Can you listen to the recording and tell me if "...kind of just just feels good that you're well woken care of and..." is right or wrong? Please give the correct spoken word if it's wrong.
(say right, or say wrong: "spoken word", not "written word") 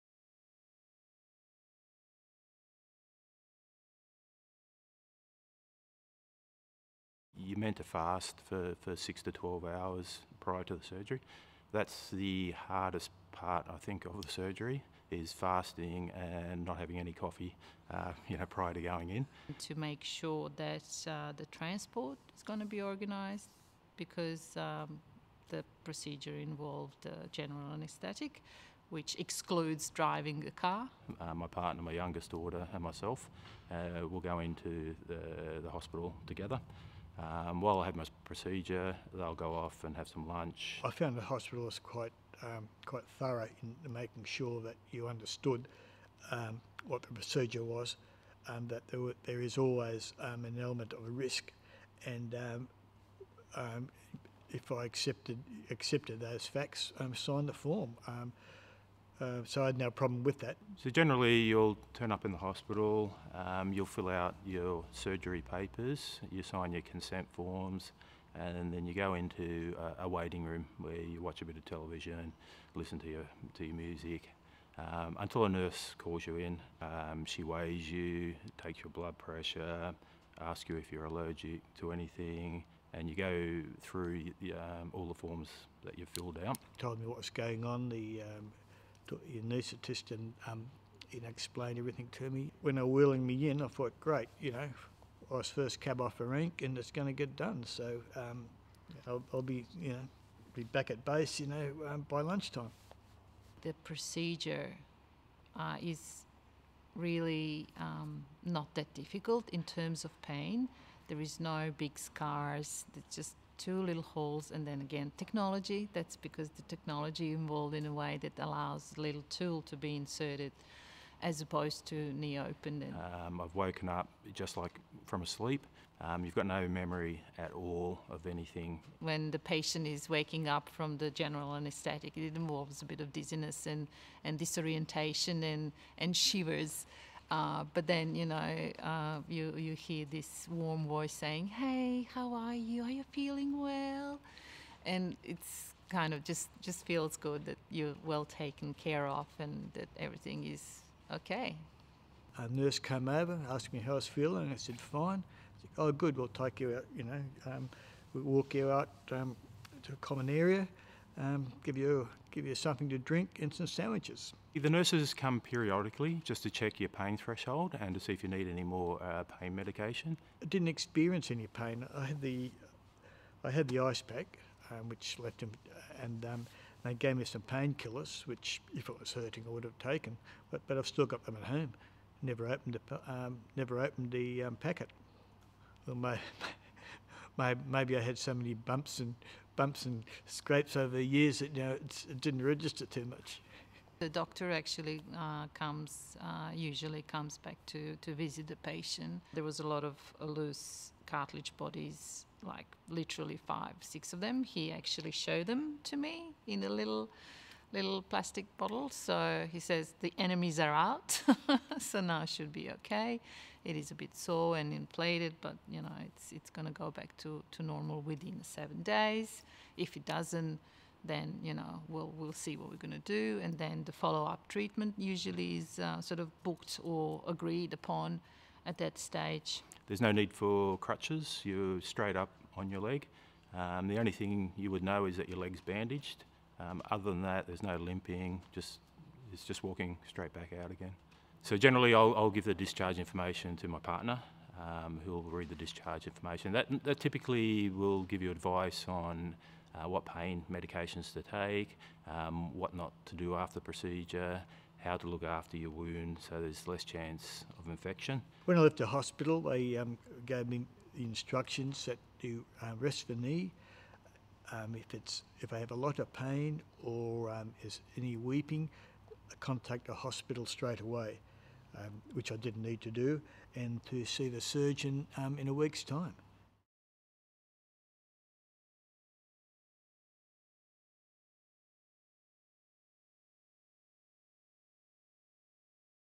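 wrong: "taken", not "woken".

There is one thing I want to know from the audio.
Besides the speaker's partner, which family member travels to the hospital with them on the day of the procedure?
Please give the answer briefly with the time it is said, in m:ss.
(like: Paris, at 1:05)
youngest daughter, at 0:31.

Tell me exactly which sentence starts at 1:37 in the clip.
So um, I'll, I'll, be, you know, be back at base, you know, um, by lunchtime.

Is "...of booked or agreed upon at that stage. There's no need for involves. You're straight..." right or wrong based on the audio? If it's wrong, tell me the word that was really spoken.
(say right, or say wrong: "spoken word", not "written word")
wrong: "crutches", not "involves".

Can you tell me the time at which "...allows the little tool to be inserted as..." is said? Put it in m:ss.
1:58.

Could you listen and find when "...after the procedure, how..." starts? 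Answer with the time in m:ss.
4:13.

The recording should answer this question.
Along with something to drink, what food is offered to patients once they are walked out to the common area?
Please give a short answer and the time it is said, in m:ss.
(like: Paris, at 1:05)
sandwiches, at 2:43.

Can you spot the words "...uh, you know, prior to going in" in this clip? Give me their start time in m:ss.
0:17.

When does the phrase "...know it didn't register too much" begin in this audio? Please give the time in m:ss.
3:11.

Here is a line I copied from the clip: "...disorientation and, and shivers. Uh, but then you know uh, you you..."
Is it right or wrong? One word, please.
right.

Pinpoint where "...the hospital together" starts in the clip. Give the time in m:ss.
0:35.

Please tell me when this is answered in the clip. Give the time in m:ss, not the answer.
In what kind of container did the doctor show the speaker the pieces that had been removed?
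3:28.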